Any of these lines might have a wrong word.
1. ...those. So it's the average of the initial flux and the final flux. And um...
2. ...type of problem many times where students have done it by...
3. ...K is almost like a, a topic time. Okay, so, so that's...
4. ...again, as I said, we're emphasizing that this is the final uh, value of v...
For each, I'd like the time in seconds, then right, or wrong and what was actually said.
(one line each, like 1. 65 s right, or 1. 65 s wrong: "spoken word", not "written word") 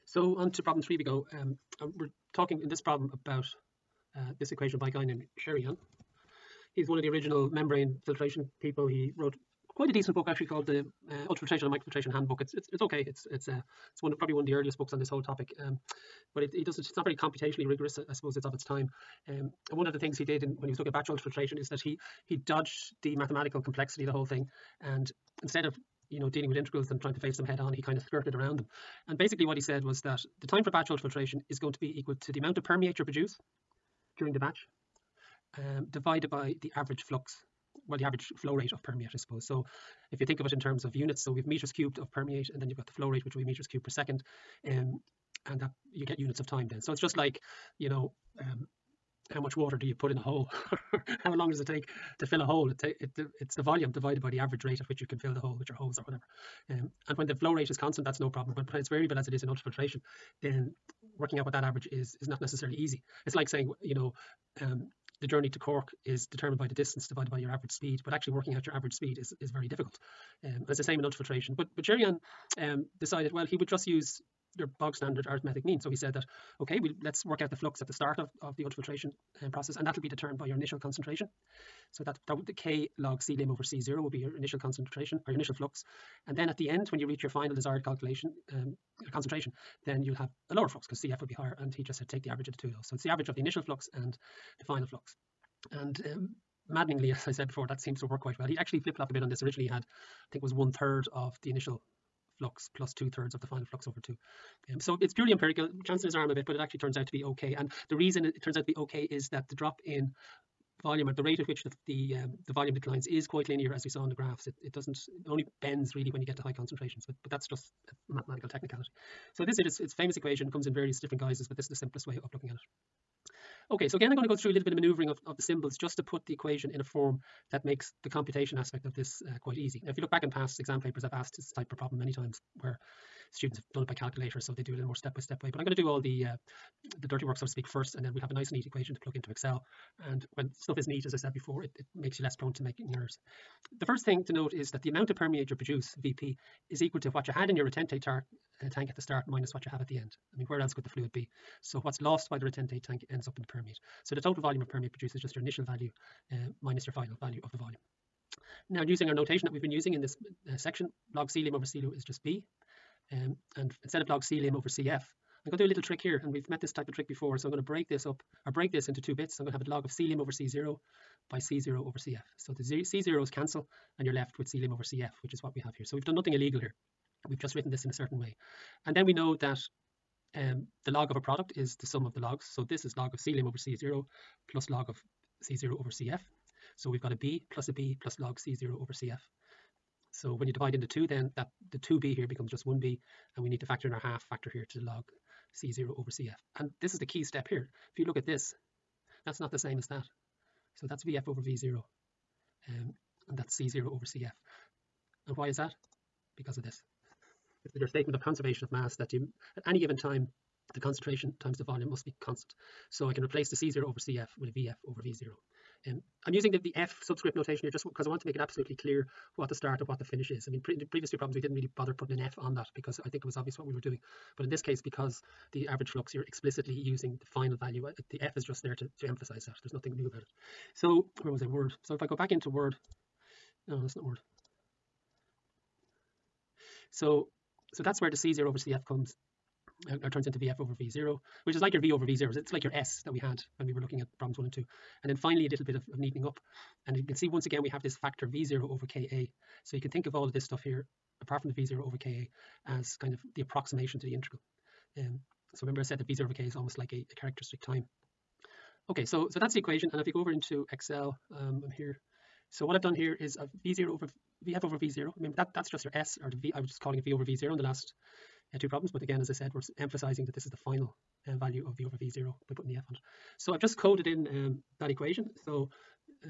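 1. 92 s right
2. 131 s right
3. 256 s wrong: "characteristic", not "topic"
4. 269 s right.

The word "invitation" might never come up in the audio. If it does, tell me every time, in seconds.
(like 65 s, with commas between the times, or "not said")
not said.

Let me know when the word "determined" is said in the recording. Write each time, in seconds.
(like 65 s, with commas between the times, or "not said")
66 s, 80 s.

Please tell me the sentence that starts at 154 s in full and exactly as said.
So the total volume of permeate produced is just your initial value uh, minus your final value of the volume.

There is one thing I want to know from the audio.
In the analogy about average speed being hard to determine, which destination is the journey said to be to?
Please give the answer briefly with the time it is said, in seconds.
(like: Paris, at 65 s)
Cork, at 65 s.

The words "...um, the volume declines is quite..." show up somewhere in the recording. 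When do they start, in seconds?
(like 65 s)
112 s.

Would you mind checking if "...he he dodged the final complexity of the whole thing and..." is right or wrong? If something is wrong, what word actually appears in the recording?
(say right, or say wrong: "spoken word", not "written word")
wrong: "mathematical", not "final".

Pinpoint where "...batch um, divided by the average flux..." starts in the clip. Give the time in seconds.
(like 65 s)
34 s.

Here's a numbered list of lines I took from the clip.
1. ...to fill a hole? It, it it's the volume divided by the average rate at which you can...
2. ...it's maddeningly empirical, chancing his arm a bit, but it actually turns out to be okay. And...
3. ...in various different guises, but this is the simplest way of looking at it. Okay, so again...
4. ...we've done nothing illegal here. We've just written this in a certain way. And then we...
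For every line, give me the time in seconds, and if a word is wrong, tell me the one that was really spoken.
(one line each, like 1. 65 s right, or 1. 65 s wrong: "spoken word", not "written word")
1. 52 s right
2. 105 s wrong: "purely", not "maddeningly"
3. 120 s right
4. 175 s right.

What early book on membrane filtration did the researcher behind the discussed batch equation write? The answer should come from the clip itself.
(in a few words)
Ultrafiltration and Microfiltration Handbook.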